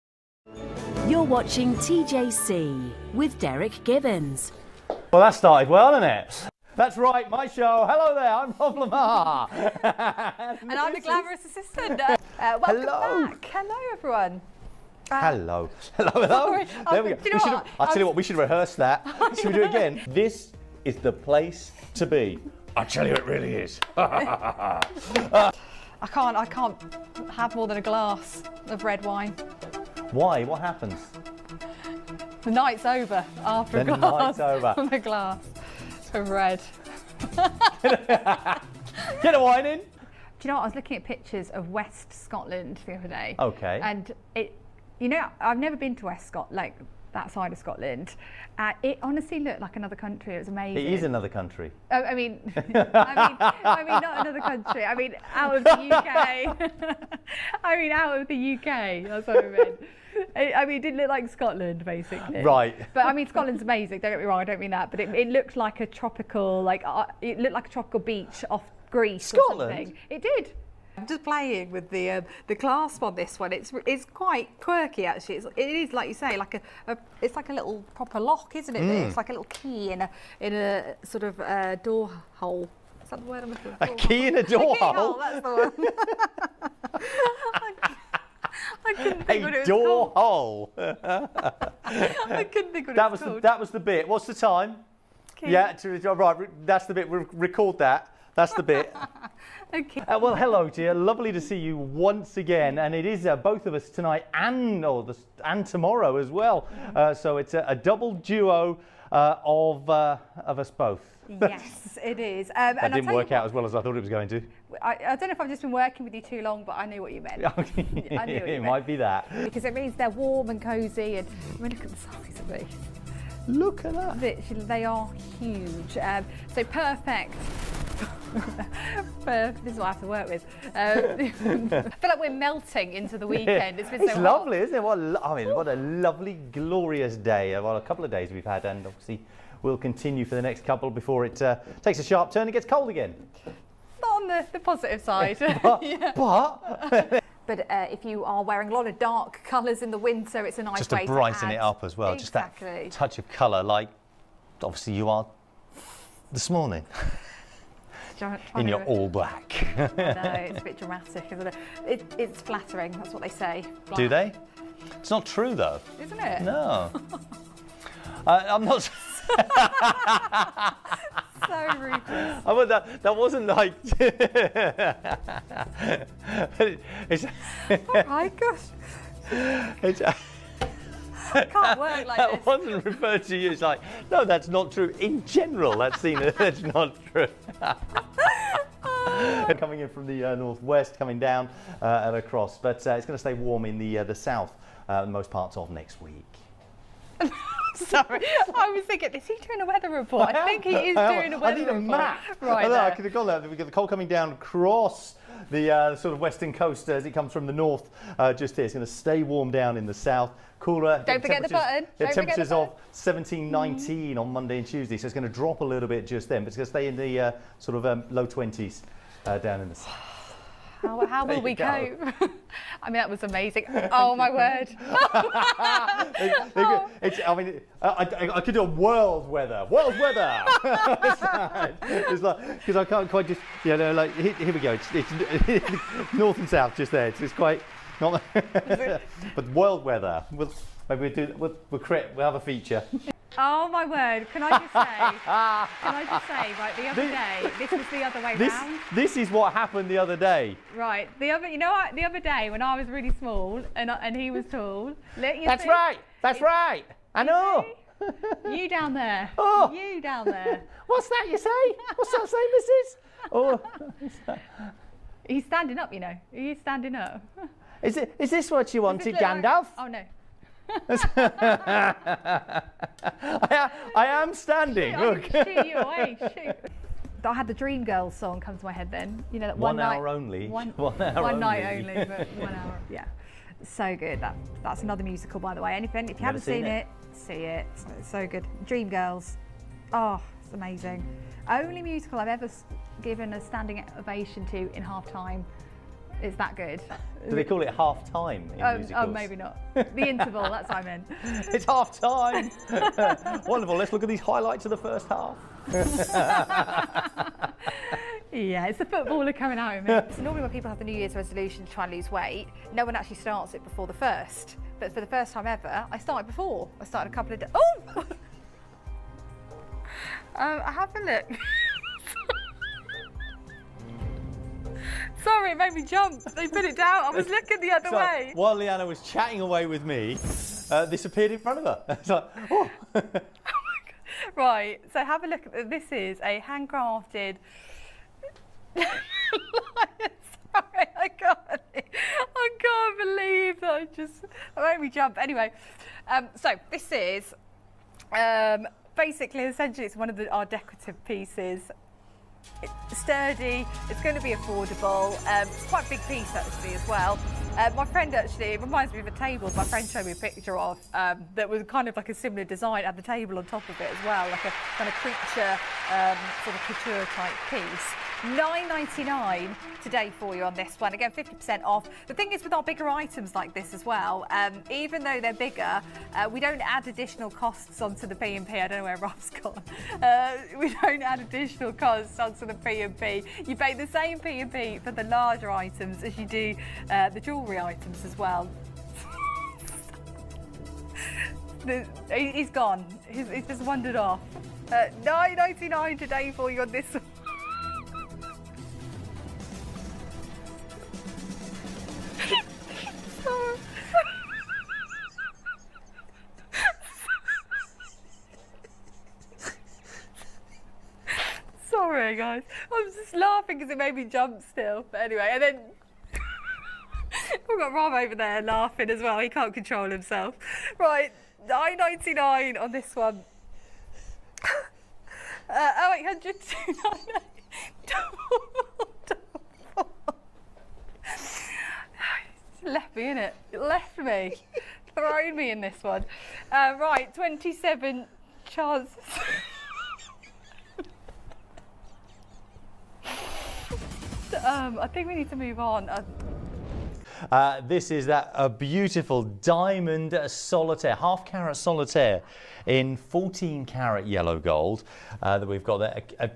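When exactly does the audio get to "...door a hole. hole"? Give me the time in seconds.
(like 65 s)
84 s.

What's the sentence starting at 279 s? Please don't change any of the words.
You know that one, one night, hour only.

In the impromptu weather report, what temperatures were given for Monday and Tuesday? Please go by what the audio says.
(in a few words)
17, 19.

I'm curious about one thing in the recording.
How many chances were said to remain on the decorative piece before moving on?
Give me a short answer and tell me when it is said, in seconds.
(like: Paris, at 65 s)
27, at 437 s.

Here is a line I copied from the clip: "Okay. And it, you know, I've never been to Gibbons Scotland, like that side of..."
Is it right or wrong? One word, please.
wrong.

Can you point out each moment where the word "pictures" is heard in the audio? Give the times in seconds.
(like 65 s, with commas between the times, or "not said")
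41 s, 360 s.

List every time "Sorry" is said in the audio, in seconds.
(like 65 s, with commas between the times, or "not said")
16 s, 197 s, 325 s, 338 s.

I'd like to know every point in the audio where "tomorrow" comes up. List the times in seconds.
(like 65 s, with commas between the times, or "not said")
105 s.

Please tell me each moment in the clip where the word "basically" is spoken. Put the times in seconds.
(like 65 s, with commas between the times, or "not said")
61 s, 348 s.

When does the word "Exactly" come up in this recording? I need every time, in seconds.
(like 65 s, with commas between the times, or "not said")
152 s.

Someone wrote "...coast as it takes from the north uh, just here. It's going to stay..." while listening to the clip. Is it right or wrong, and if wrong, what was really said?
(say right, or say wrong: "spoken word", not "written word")
wrong: "comes", not "takes".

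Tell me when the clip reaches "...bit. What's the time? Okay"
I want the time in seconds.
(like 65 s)
93 s.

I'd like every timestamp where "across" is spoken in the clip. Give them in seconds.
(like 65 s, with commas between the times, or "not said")
192 s, 204 s.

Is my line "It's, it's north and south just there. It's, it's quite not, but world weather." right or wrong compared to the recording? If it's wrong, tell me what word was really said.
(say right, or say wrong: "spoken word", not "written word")
right.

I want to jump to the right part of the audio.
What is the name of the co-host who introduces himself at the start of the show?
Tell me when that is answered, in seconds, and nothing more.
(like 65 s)
8 s.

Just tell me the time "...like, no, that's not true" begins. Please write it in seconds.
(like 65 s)
183 s.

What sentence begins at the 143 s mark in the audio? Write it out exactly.
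Not on the, the positive side.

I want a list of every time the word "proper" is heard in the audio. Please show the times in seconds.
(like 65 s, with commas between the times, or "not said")
77 s.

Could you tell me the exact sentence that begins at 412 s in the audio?
Guys, I'm just laughing because it made me jump still.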